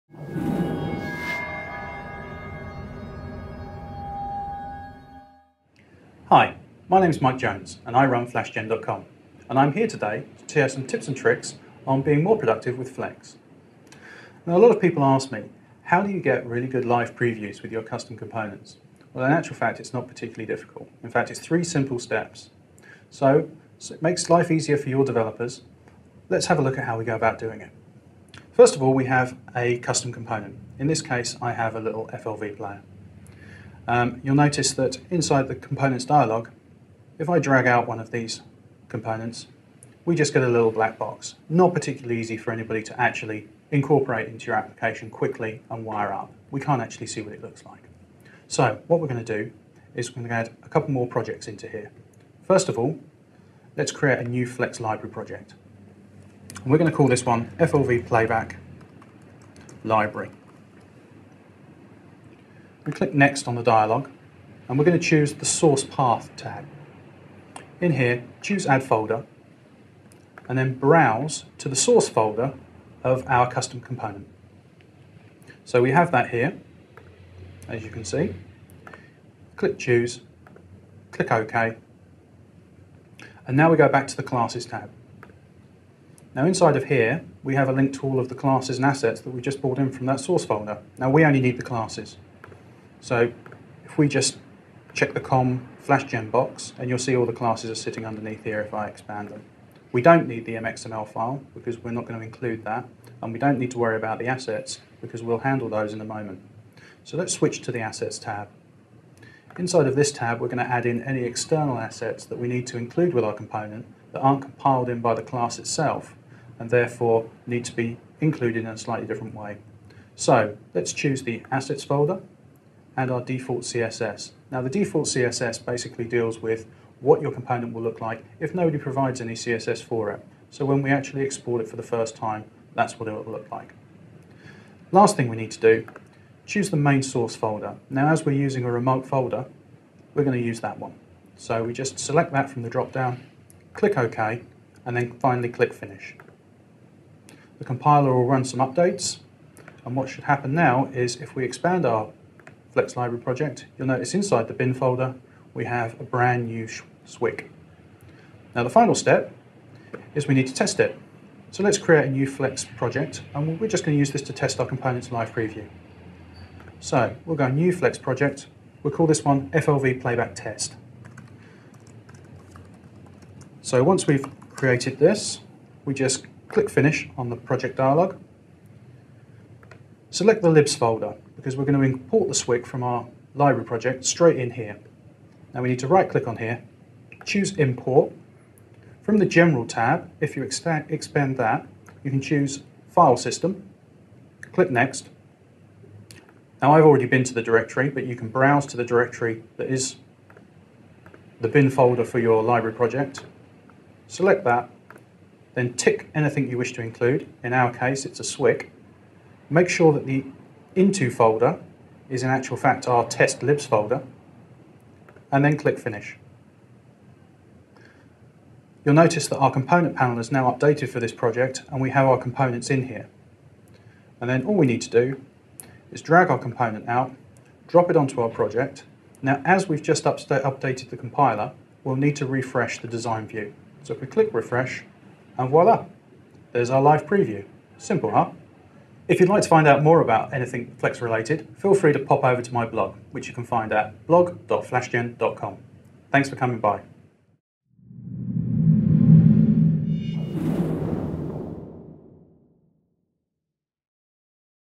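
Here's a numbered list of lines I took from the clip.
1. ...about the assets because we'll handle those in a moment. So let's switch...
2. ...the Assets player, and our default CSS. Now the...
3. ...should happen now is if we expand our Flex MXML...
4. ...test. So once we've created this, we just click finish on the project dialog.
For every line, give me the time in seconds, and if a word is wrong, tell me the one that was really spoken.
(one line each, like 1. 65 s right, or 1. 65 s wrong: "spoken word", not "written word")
1. 103 s right
2. 121 s wrong: "folder", not "player"
3. 150 s wrong: "Library", not "MXML"
4. 170 s right.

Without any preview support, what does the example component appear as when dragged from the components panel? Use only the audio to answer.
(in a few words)
A little black box.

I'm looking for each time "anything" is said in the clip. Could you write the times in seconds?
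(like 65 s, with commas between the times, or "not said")
206 s, 240 s.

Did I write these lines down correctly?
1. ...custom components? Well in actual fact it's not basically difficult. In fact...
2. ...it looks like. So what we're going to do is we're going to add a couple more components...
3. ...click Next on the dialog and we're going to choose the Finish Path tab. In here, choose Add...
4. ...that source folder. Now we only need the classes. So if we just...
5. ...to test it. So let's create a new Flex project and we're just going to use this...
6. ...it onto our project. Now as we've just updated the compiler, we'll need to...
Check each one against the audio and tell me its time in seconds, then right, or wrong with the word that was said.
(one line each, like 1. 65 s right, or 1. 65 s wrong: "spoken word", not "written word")
1. 17 s wrong: "particularly", not "basically"
2. 47 s wrong: "projects", not "components"
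3. 62 s wrong: "Source", not "Finish"
4. 90 s right
5. 160 s right
6. 227 s right.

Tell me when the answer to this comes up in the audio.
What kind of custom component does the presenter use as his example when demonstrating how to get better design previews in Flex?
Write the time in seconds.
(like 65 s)
32 s.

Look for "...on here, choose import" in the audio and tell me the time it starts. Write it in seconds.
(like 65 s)
186 s.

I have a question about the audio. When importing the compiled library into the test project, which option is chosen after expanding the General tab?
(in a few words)
File system.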